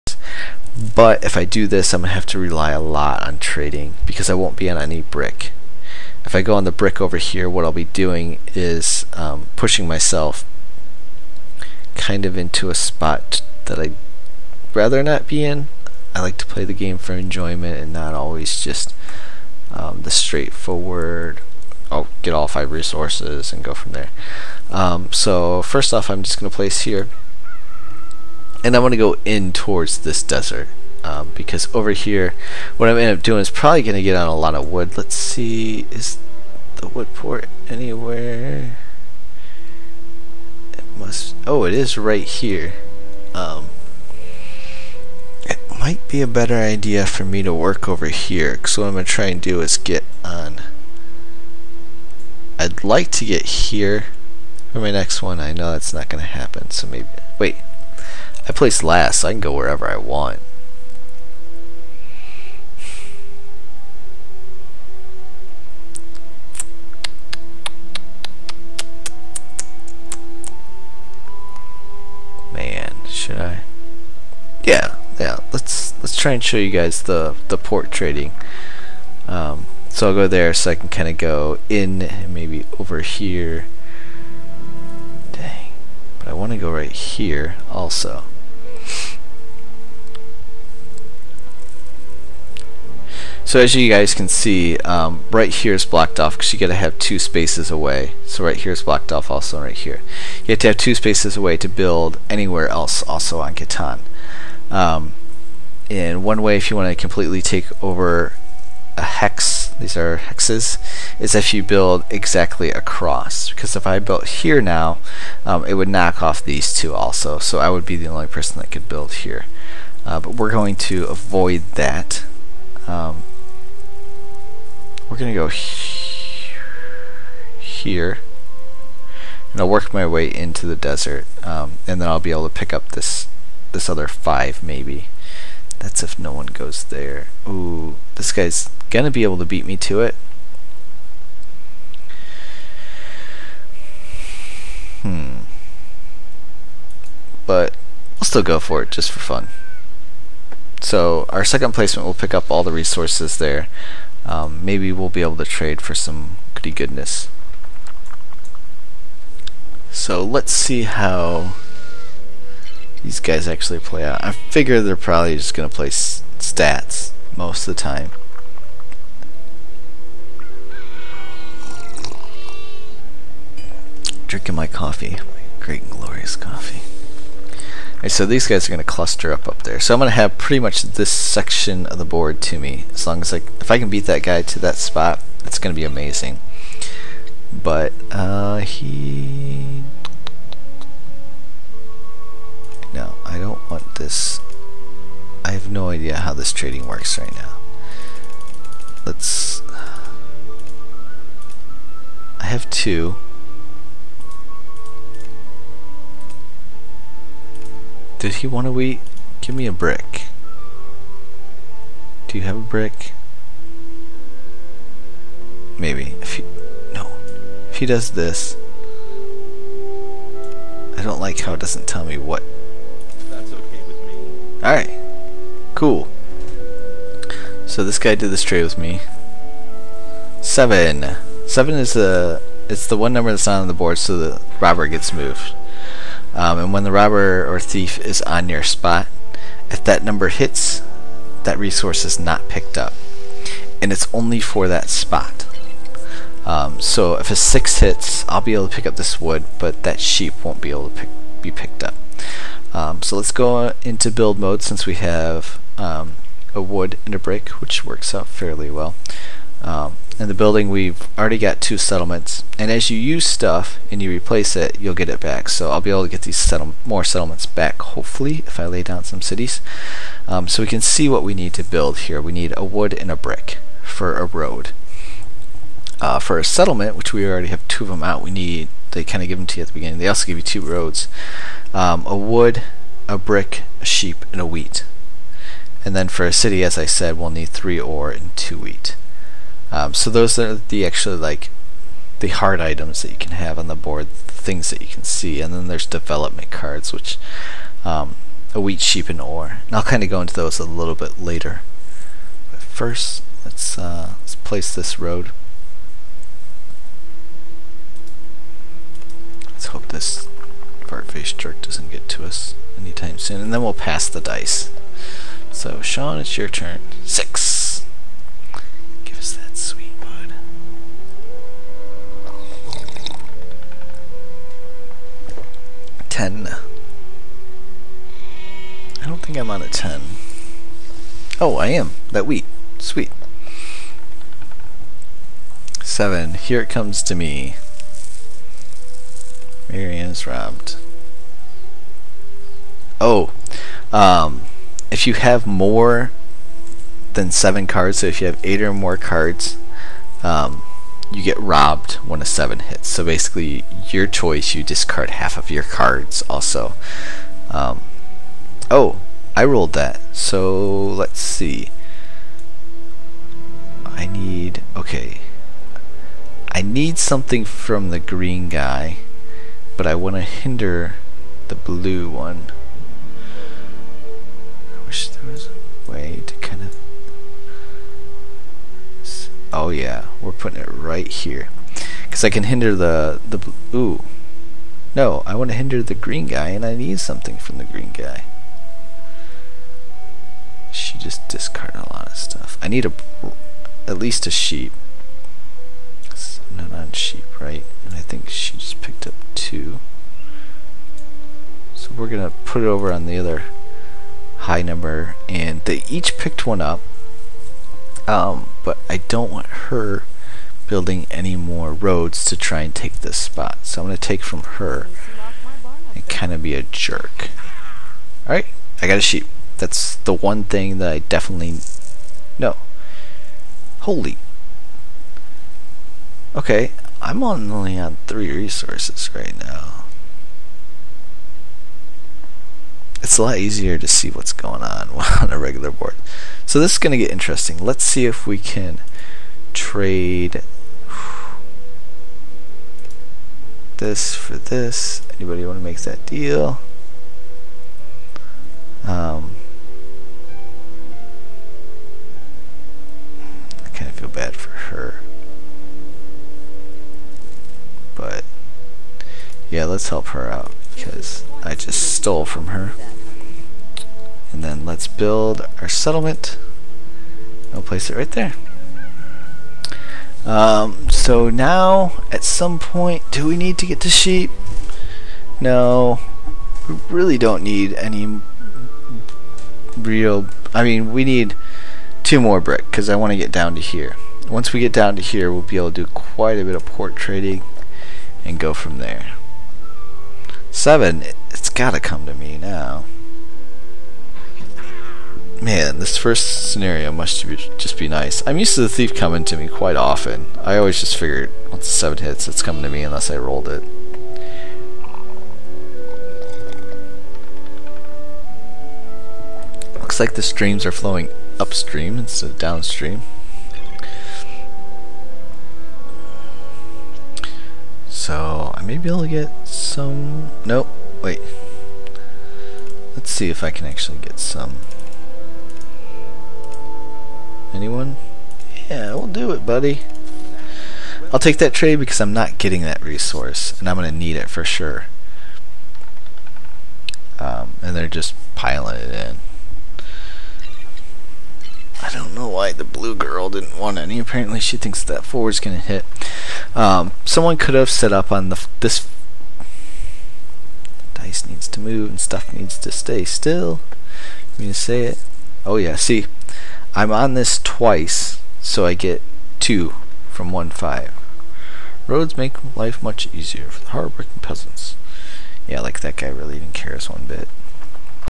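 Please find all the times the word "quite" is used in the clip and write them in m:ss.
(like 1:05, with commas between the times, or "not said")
8:05, 8:19.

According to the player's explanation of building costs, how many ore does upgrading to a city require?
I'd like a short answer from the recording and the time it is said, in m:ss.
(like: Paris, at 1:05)
3, at 4:47.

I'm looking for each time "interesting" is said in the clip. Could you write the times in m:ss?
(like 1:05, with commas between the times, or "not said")
7:17.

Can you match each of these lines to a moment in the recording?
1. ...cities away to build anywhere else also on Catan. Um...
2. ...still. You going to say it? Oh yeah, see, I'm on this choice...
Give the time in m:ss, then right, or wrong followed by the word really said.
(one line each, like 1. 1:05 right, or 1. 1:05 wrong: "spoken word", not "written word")
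1. 1:40 wrong: "spaces", not "cities"
2. 9:13 wrong: "twice", not "choice".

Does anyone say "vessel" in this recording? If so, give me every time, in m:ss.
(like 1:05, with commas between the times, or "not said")
not said.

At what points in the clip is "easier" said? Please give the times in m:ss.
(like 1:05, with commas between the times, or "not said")
7:13, 9:23.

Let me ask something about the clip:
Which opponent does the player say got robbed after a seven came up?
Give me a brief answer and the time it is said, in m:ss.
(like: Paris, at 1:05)
Marianne, at 5:39.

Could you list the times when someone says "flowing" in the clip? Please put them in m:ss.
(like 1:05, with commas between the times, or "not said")
8:30.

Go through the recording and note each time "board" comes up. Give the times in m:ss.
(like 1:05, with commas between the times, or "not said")
3:02, 3:53, 4:53, 7:15.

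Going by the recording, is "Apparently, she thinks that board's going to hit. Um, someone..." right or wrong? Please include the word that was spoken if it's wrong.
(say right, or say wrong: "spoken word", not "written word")
wrong: "forward", not "board".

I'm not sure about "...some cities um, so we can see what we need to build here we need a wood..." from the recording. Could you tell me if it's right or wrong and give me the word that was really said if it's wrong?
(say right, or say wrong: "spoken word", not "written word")
right.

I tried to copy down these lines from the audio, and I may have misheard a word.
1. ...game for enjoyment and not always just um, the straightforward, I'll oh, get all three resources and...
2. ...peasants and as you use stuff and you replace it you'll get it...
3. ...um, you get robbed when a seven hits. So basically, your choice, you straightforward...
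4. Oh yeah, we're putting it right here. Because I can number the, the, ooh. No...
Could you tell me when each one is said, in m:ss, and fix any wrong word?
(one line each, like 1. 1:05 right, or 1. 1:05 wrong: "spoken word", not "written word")
1. 0:16 wrong: "five", not "three"
2. 4:21 wrong: "settlements", not "peasants"
3. 5:50 wrong: "discard", not "straightforward"
4. 6:19 wrong: "hinder", not "number".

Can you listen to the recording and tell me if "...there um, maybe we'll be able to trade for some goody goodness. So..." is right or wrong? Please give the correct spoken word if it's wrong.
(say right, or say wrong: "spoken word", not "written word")
right.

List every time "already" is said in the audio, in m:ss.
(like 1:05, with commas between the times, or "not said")
4:21, 4:37.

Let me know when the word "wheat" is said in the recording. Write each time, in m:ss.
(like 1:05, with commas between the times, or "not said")
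4:44, 4:48, 4:58, 5:32.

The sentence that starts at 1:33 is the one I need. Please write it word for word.
So as you guys can see, um, right here is blocked off because you got to have two spaces away.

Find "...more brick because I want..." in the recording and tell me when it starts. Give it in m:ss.
8:02.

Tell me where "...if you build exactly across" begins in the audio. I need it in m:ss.
1:51.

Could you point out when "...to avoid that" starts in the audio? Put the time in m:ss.
2:00.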